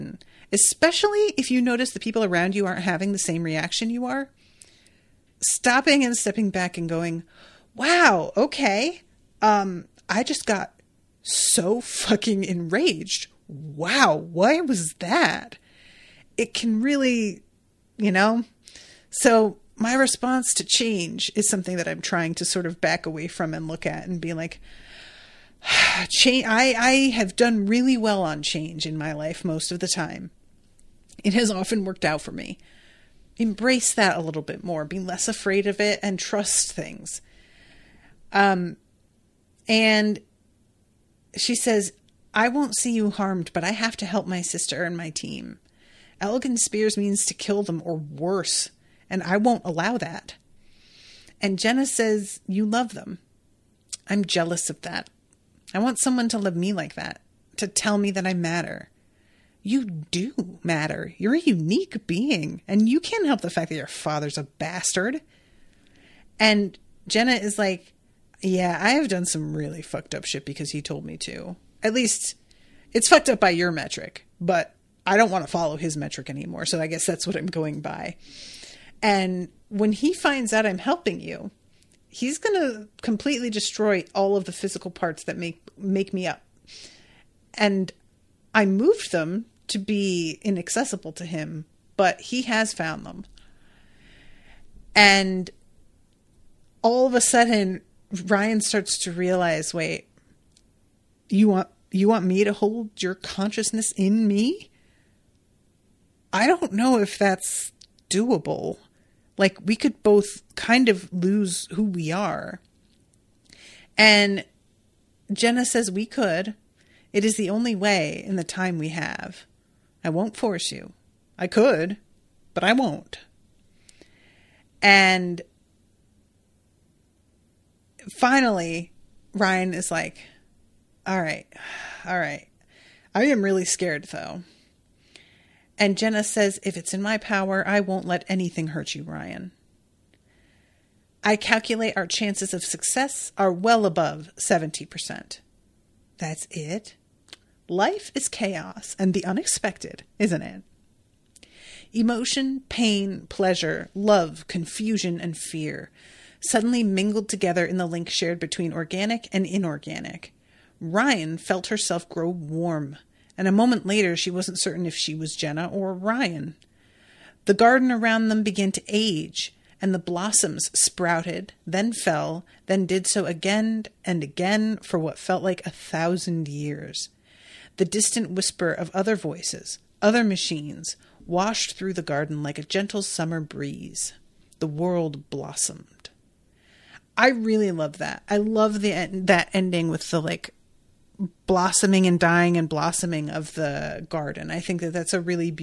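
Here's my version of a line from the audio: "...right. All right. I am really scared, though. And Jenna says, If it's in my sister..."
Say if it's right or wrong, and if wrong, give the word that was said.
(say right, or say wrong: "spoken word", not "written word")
wrong: "power", not "sister".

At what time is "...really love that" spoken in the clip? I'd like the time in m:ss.
3:07.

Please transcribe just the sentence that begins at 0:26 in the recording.
I, I have done really well on change in my life most of the time.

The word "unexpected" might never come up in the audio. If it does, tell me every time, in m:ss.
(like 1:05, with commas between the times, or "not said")
2:29.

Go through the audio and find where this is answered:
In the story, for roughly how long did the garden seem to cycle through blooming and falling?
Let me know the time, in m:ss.
2:55.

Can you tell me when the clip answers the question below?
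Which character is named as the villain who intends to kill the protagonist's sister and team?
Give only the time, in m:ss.
0:46.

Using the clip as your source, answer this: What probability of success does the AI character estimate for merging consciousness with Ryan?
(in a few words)
above 70%.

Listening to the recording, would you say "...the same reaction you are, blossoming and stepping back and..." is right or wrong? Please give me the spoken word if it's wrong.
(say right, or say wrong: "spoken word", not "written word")
wrong: "stopping", not "blossoming".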